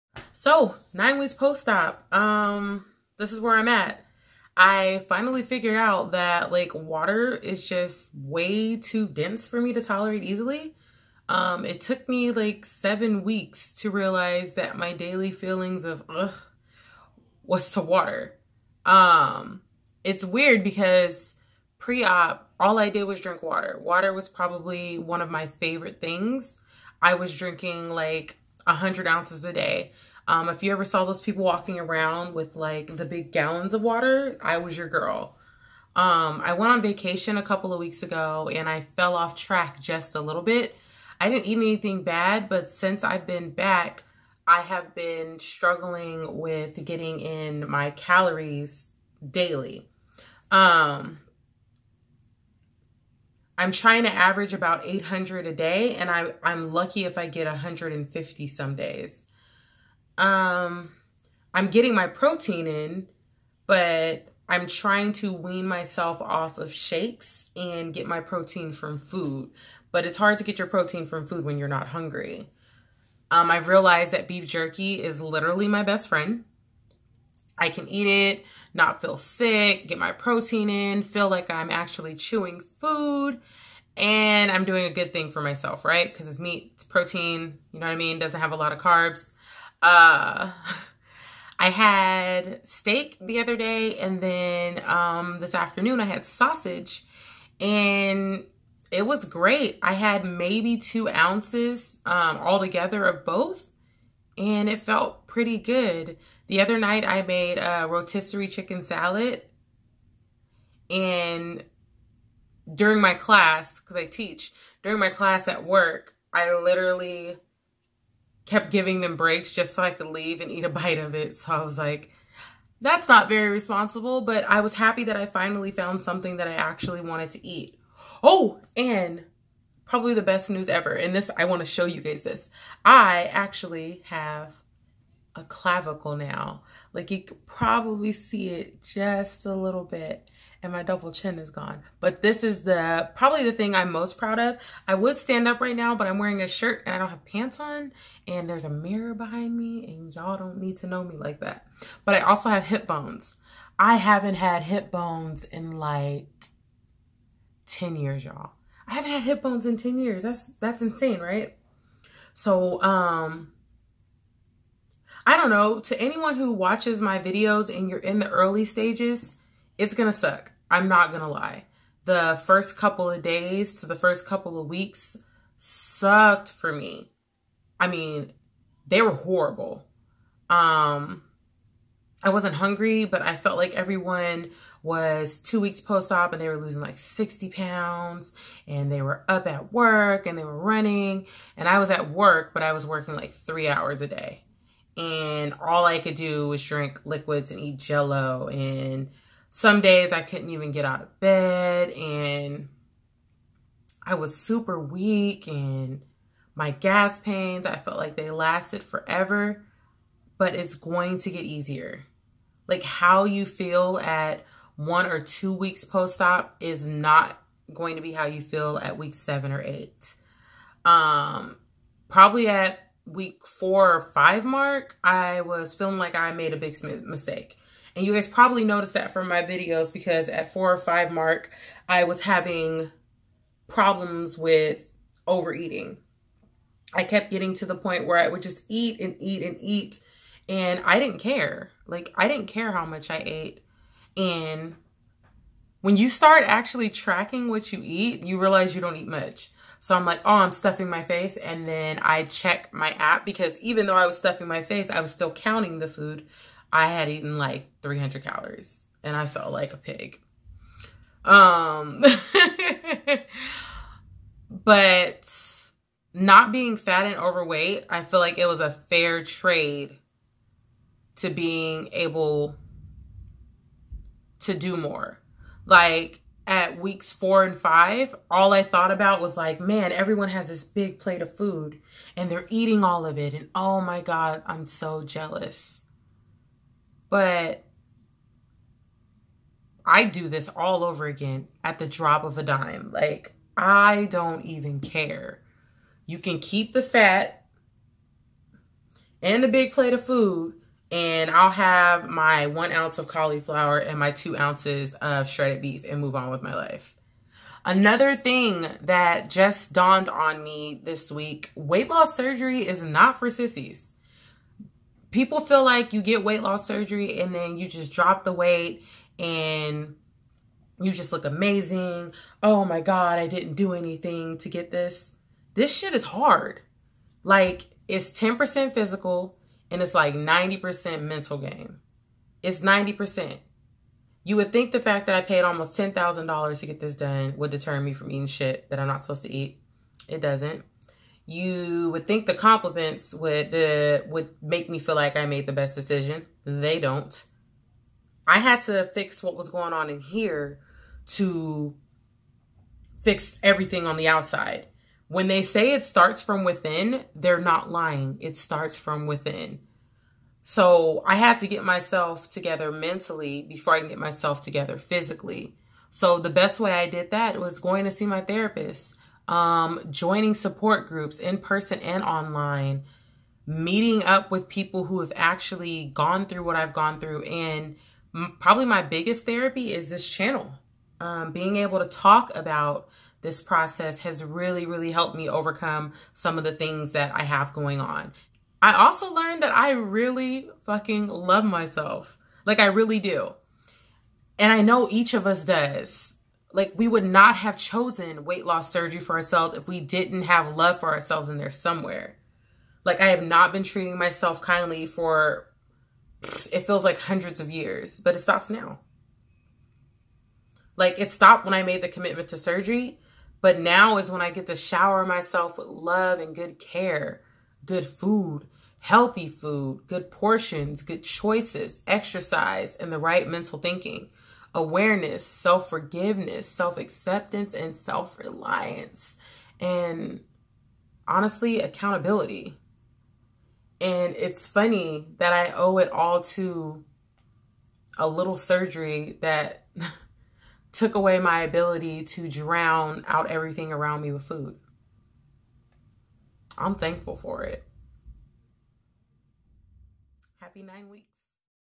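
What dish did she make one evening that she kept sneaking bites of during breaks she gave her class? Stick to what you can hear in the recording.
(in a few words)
Rotisserie chicken salad.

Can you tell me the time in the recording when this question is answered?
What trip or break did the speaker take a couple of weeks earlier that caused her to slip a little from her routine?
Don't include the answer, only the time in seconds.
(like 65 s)
36 s.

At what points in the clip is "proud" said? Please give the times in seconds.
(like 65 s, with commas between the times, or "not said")
144 s.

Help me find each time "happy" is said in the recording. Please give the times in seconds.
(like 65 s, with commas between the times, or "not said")
124 s, 450 s.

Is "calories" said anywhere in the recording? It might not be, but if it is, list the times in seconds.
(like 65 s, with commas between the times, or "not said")
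47 s, 258 s.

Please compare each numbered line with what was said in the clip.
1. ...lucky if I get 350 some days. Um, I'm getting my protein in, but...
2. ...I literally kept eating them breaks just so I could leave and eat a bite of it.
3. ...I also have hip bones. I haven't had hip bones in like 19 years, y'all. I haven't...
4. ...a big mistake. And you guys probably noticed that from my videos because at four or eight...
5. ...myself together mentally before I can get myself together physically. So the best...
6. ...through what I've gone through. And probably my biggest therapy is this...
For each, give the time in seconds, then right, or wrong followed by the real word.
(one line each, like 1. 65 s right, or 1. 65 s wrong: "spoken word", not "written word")
1. 56 s wrong: "150", not "350"
2. 116 s wrong: "giving", not "eating"
3. 152 s wrong: "10", not "19"
4. 226 s wrong: "five", not "eight"
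5. 361 s right
6. 376 s right.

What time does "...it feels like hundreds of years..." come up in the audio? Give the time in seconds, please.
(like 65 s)
406 s.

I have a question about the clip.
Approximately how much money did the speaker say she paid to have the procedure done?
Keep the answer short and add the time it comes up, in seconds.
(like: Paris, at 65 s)
$10,000, at 335 s.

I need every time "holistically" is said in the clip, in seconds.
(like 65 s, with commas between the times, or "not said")
not said.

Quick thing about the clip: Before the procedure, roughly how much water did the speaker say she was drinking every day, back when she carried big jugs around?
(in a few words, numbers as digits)
100 ounces.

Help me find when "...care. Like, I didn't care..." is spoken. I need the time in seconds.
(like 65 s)
241 s.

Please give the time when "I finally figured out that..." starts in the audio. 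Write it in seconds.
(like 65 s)
4 s.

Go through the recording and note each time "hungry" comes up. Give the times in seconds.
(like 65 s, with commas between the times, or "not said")
71 s, 182 s.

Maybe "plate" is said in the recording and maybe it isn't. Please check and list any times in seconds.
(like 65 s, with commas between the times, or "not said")
280 s, 299 s.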